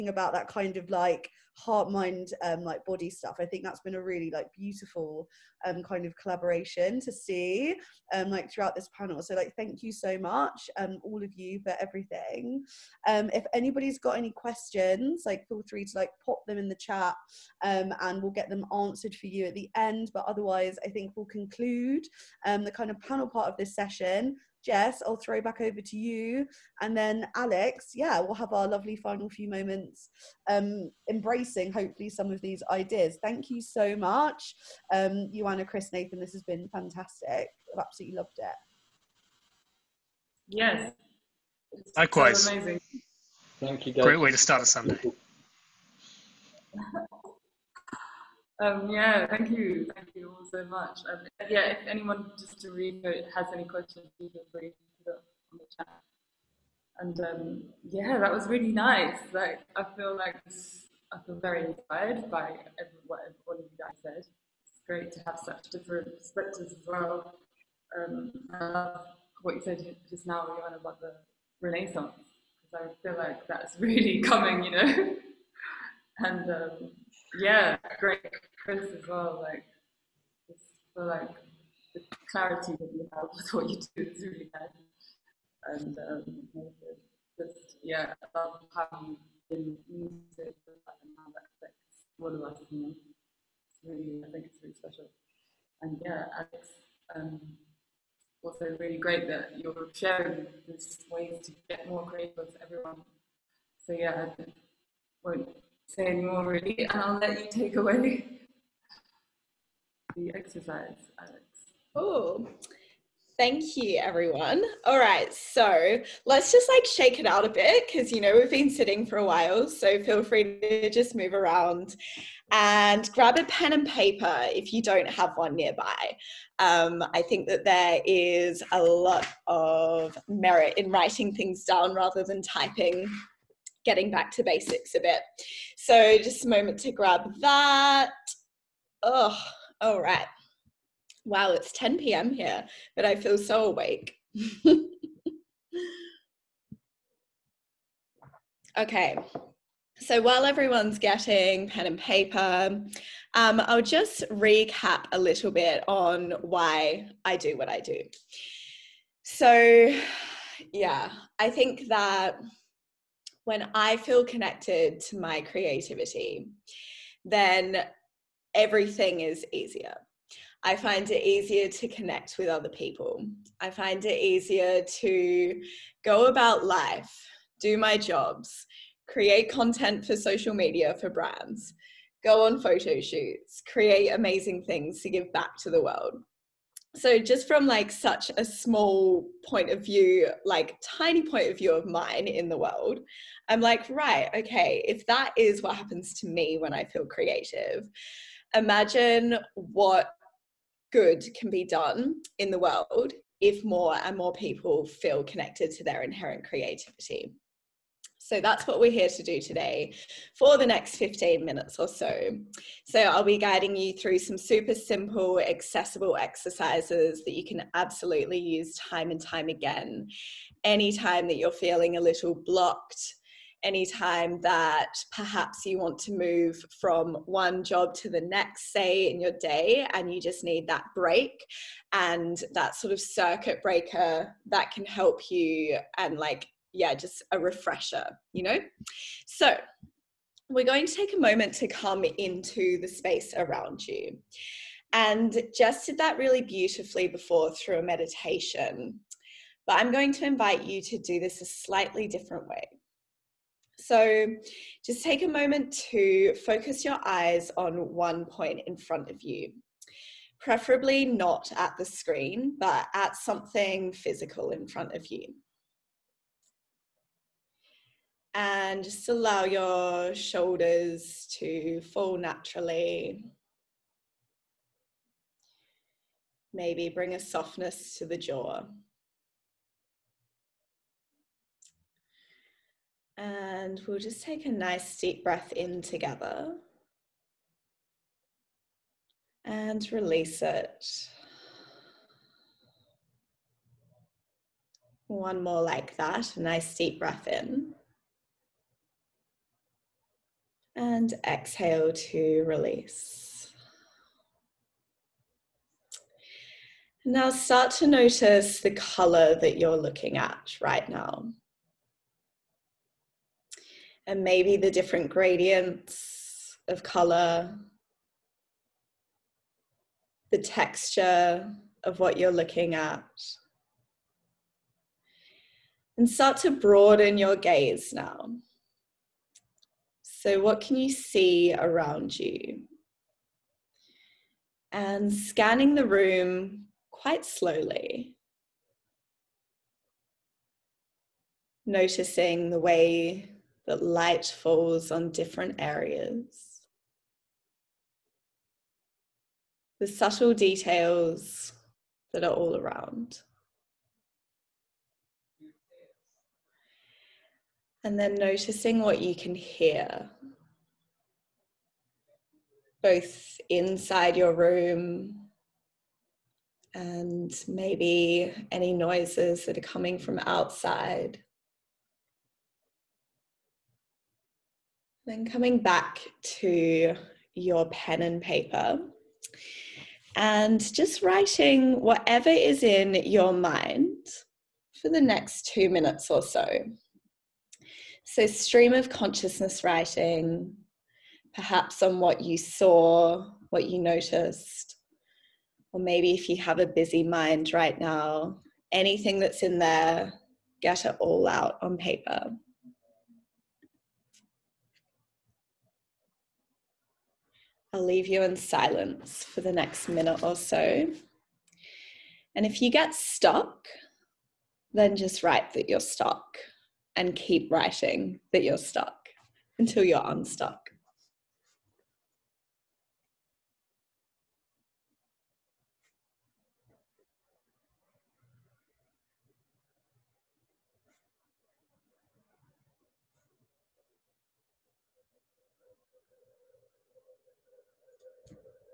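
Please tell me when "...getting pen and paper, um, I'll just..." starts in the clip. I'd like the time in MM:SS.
02:30.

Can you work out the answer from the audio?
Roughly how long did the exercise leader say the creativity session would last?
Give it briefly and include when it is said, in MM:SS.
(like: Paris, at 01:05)
15 minutes, at 03:30.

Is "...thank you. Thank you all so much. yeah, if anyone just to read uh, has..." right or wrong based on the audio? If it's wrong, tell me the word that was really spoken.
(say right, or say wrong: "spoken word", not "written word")
right.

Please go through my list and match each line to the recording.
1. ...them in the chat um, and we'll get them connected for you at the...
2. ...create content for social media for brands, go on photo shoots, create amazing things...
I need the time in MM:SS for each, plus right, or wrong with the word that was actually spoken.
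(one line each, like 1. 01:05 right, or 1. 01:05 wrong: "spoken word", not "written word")
1. 00:16 wrong: "answered", not "connected"
2. 02:59 right.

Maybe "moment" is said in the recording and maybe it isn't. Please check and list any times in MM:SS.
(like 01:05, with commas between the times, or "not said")
00:29, 02:16, 04:01, 04:15.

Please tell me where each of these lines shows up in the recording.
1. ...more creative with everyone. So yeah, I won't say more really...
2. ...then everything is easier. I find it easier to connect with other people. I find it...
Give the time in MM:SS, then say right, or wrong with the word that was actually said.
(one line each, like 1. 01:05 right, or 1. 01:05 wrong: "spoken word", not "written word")
1. 01:41 right
2. 02:47 right.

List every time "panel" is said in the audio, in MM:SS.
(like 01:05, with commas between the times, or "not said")
00:08, 00:23.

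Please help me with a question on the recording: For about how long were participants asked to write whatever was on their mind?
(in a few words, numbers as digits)
2 minutes.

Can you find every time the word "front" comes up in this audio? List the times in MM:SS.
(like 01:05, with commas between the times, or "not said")
04:18, 04:24.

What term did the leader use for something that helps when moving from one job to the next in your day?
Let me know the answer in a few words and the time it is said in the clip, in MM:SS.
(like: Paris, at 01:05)
circuit breaker, at 03:52.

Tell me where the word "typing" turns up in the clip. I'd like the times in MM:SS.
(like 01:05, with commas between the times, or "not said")
02:12.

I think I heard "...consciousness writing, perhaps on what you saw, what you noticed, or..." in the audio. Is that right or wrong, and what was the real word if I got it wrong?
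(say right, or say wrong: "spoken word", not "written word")
right.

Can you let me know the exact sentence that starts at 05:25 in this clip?
And start to broaden your gaze now.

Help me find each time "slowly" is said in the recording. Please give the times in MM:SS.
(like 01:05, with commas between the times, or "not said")
05:37.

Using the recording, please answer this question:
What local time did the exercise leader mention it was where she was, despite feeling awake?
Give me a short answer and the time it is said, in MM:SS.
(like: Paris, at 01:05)
10 p.m., at 02:21.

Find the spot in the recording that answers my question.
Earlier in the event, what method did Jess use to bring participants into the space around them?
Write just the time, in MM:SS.
04:07.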